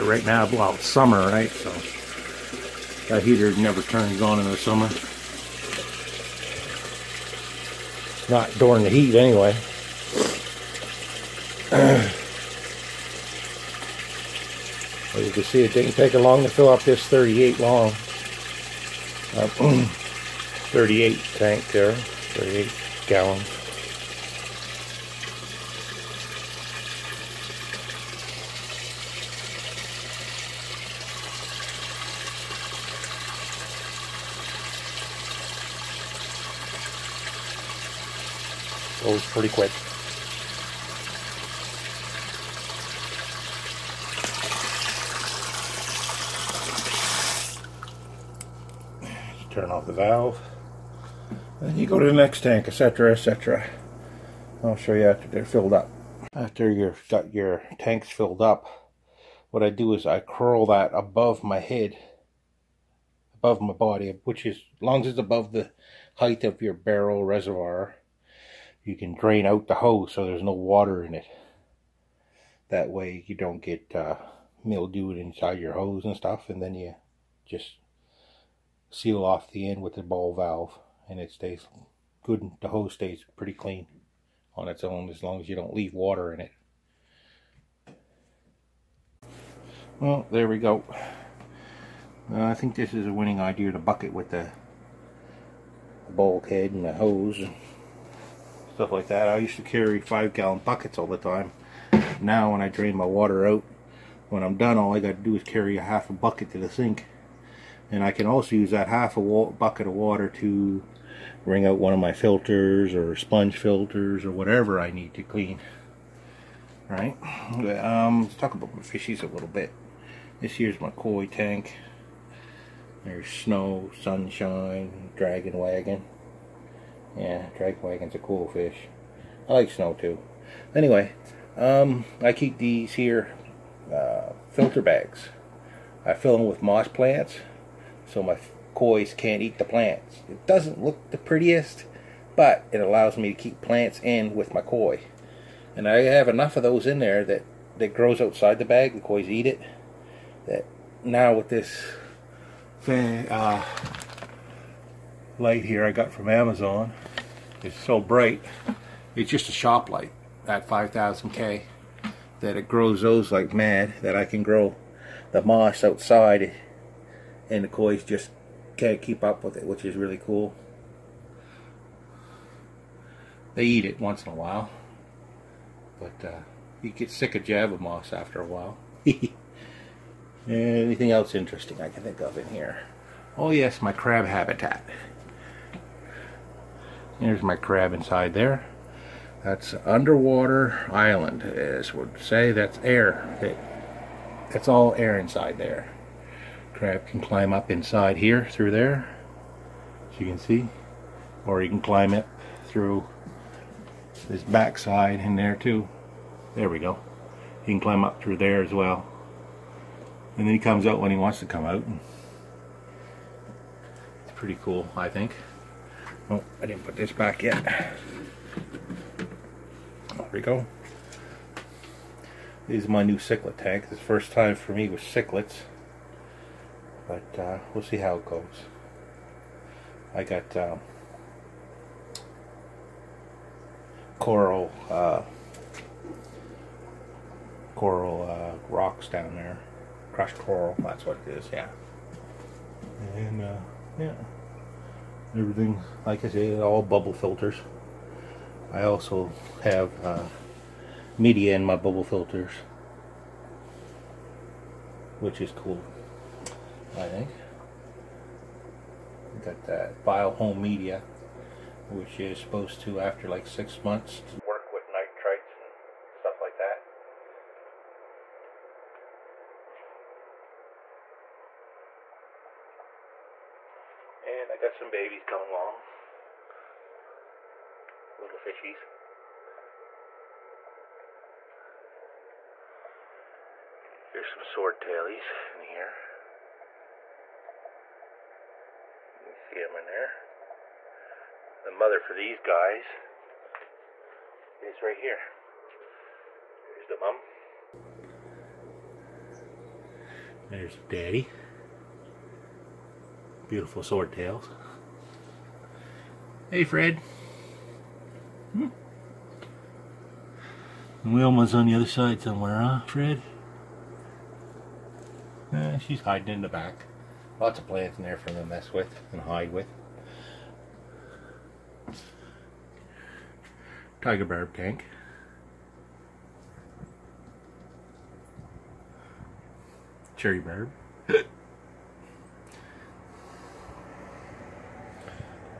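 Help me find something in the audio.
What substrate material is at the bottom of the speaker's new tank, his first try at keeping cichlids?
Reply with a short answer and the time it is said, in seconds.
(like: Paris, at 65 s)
Crushed coral, at 240 s.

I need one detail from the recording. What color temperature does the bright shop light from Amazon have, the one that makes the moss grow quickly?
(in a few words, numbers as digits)
5000K.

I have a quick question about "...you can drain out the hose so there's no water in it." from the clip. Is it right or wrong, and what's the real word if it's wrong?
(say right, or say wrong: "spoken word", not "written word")
right.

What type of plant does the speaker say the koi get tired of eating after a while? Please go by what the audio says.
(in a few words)
Java moss.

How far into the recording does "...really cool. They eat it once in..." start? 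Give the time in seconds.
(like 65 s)
169 s.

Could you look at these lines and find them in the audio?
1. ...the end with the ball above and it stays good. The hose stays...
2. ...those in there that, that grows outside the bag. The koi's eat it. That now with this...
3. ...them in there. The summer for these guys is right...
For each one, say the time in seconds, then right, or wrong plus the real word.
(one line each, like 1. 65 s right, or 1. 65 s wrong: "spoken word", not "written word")
1. 79 s wrong: "valve", not "above"
2. 146 s right
3. 289 s wrong: "mother", not "summer".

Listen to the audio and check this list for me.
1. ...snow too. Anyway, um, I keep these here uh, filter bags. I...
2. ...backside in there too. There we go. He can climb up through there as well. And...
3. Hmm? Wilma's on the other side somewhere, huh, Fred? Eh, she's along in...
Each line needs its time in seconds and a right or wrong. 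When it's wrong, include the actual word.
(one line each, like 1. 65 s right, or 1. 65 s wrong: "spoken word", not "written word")
1. 129 s right
2. 204 s right
3. 308 s wrong: "hiding", not "along".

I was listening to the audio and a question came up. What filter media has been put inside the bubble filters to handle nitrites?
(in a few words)
bio home.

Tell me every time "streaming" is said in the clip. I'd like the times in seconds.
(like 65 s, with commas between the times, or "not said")
not said.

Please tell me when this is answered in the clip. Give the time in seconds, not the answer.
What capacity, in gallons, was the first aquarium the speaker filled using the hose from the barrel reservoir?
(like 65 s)
21 s.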